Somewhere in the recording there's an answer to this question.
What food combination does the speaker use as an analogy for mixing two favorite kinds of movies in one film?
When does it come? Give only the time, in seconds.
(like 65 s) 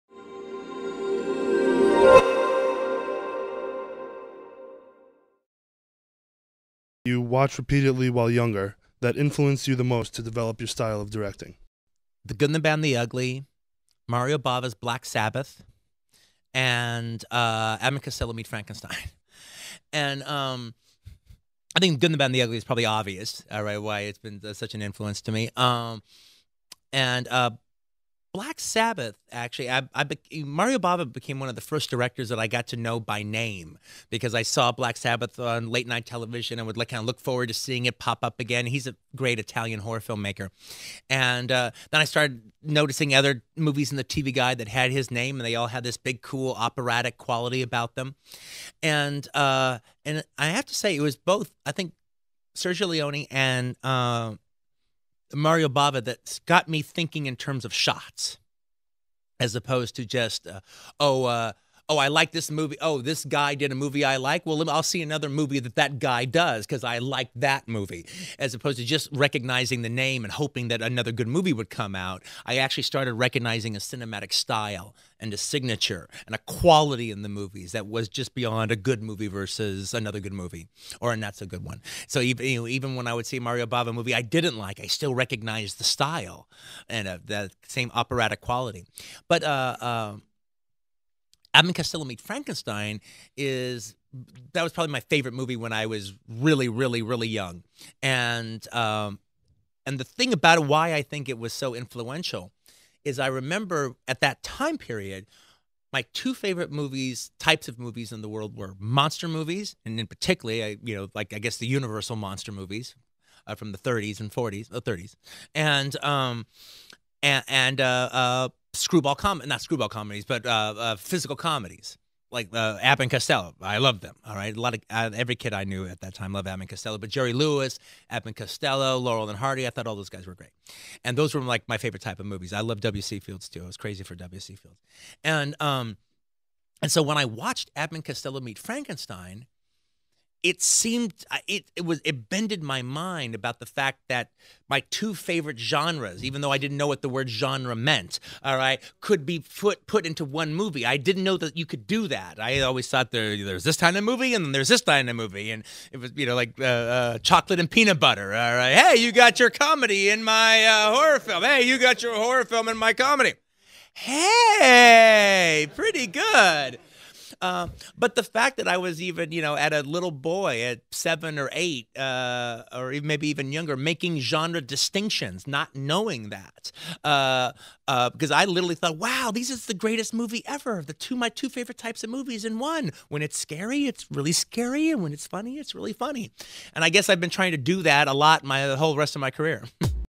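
157 s.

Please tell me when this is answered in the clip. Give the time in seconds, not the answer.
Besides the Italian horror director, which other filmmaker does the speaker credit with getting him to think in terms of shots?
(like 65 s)
52 s.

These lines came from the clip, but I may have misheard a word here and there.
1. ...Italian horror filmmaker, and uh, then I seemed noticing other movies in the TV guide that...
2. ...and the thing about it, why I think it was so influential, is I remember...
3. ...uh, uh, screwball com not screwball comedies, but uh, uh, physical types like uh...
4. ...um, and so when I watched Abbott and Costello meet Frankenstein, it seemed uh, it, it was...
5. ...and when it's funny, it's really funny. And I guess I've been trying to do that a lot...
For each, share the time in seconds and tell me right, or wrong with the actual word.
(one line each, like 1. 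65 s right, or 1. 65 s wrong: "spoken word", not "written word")
1. 39 s wrong: "started", not "seemed"
2. 99 s right
3. 117 s wrong: "comedies", not "types"
4. 135 s right
5. 184 s right.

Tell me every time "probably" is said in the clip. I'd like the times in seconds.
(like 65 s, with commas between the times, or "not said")
22 s, 94 s.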